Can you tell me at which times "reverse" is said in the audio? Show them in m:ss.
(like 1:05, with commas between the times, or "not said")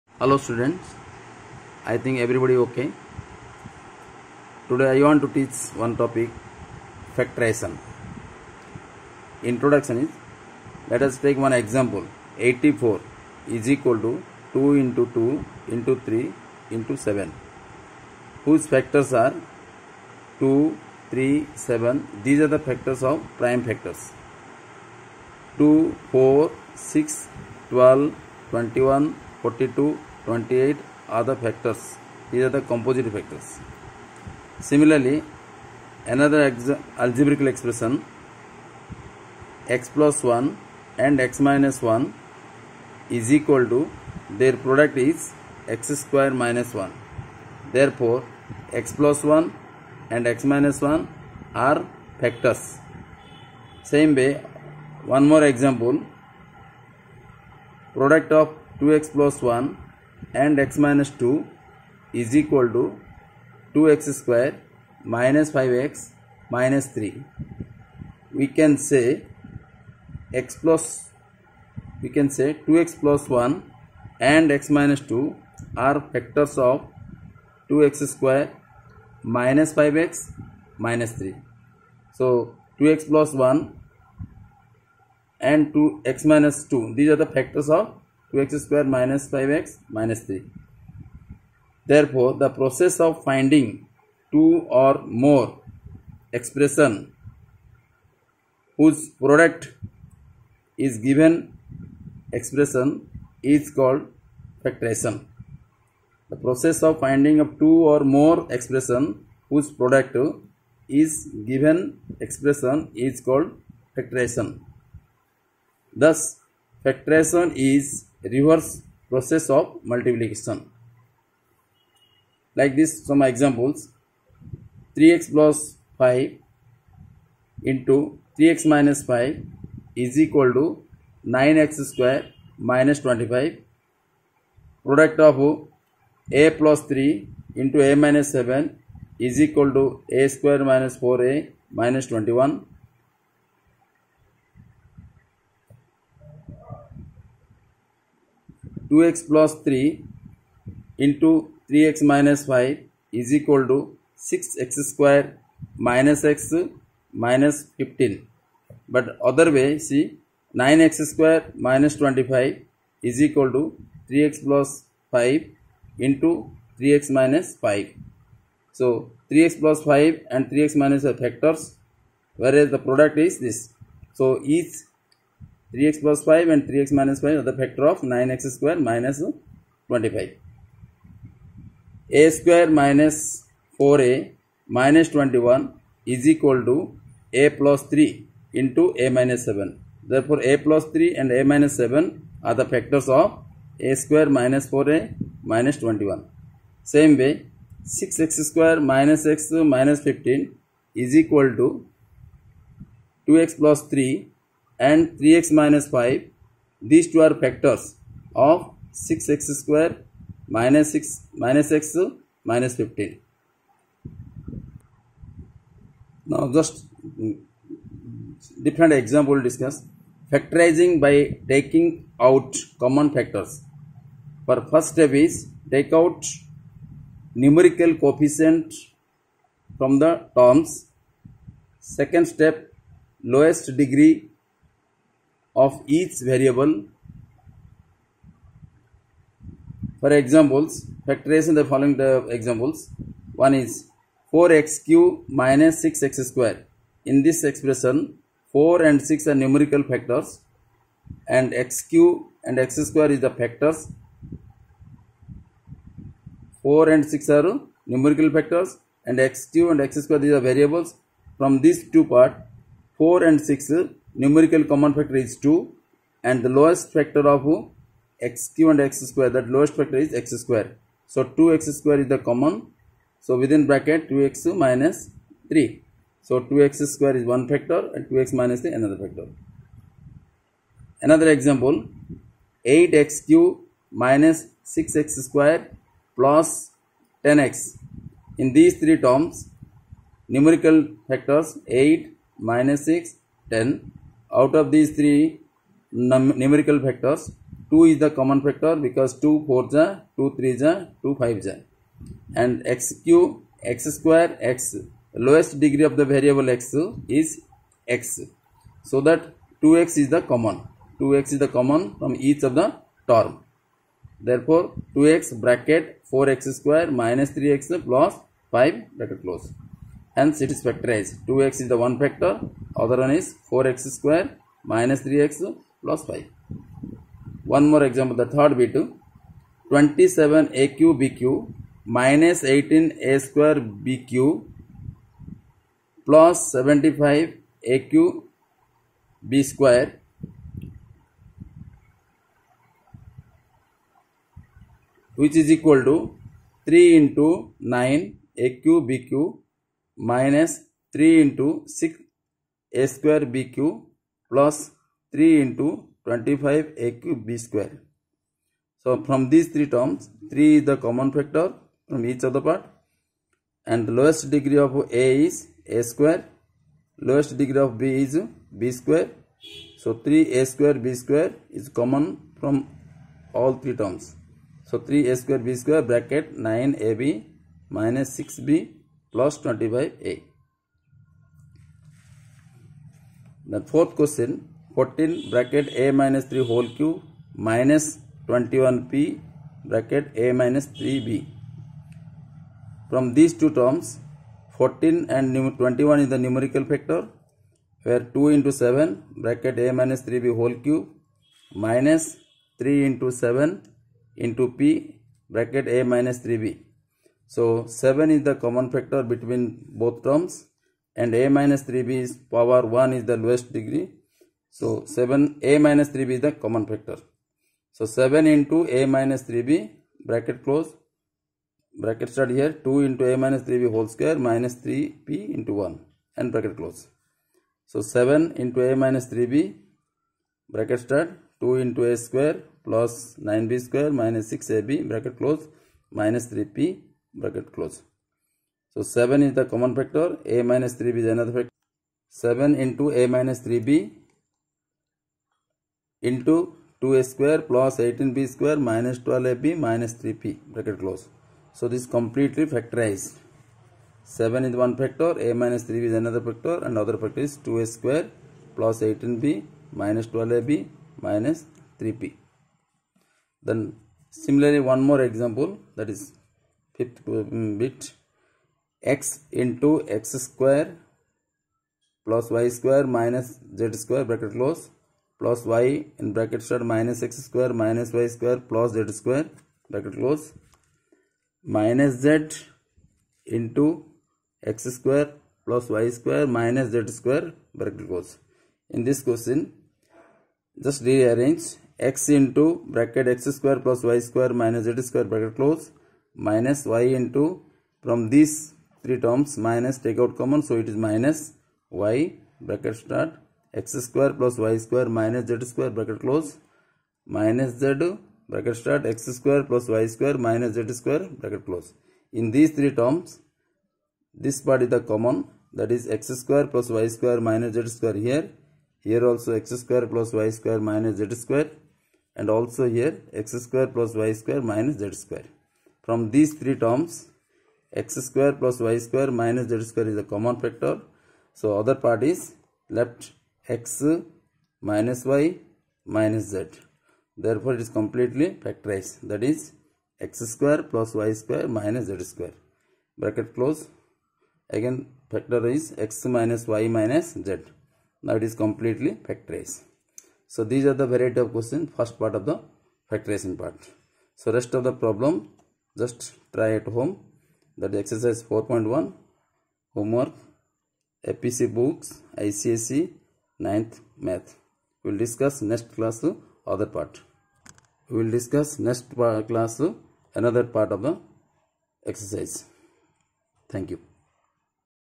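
1:58.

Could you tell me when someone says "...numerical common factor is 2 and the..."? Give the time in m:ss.
4:24.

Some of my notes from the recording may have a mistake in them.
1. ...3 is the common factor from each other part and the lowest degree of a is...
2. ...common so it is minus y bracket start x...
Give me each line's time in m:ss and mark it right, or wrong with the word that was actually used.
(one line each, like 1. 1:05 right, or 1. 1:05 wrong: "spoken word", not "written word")
1. 6:00 right
2. 8:20 right.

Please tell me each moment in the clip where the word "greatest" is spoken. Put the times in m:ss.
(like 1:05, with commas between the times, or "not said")
not said.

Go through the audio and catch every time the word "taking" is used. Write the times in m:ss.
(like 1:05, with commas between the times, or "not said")
3:41.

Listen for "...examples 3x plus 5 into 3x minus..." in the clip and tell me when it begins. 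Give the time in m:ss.
2:03.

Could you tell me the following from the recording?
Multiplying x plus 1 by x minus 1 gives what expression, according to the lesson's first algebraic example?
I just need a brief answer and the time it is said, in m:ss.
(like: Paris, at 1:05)
x² − 1, at 0:45.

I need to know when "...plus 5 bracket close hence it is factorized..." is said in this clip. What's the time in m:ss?
5:17.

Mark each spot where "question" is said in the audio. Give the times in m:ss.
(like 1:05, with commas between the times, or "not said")
6:23, 8:09, 9:11.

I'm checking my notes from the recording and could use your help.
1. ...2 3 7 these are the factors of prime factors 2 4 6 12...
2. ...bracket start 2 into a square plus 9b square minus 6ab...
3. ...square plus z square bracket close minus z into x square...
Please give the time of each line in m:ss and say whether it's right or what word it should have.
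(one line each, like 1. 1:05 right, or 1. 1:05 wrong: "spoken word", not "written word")
1. 0:19 right
2. 7:10 right
3. 7:58 right.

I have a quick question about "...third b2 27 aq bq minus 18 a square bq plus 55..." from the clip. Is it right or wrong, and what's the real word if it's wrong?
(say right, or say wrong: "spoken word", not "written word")
wrong: "75", not "55".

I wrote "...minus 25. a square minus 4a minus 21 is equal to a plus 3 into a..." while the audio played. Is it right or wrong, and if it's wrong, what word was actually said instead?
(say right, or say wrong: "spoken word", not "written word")
right.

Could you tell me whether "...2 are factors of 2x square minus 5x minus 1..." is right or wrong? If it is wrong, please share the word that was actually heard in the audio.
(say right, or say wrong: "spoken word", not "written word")
wrong: "3", not "1".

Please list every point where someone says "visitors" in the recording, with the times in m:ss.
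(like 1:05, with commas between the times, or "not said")
not said.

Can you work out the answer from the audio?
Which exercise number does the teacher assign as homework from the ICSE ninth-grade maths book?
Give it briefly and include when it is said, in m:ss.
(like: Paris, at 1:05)
4.1, at 9:18.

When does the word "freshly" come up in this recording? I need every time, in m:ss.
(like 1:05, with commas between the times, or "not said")
not said.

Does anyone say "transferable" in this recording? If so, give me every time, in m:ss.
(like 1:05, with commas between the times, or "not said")
not said.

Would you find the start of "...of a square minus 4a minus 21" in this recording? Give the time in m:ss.
3:13.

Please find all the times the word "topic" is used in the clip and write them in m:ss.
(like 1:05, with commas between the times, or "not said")
0:06.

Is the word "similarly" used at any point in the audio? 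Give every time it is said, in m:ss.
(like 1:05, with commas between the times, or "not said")
0:34, 7:44.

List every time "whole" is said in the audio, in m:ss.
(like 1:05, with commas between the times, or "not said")
6:26, 6:40, 7:03.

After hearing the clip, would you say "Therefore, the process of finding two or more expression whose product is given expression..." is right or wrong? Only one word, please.
right.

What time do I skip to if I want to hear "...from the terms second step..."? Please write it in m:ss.
3:49.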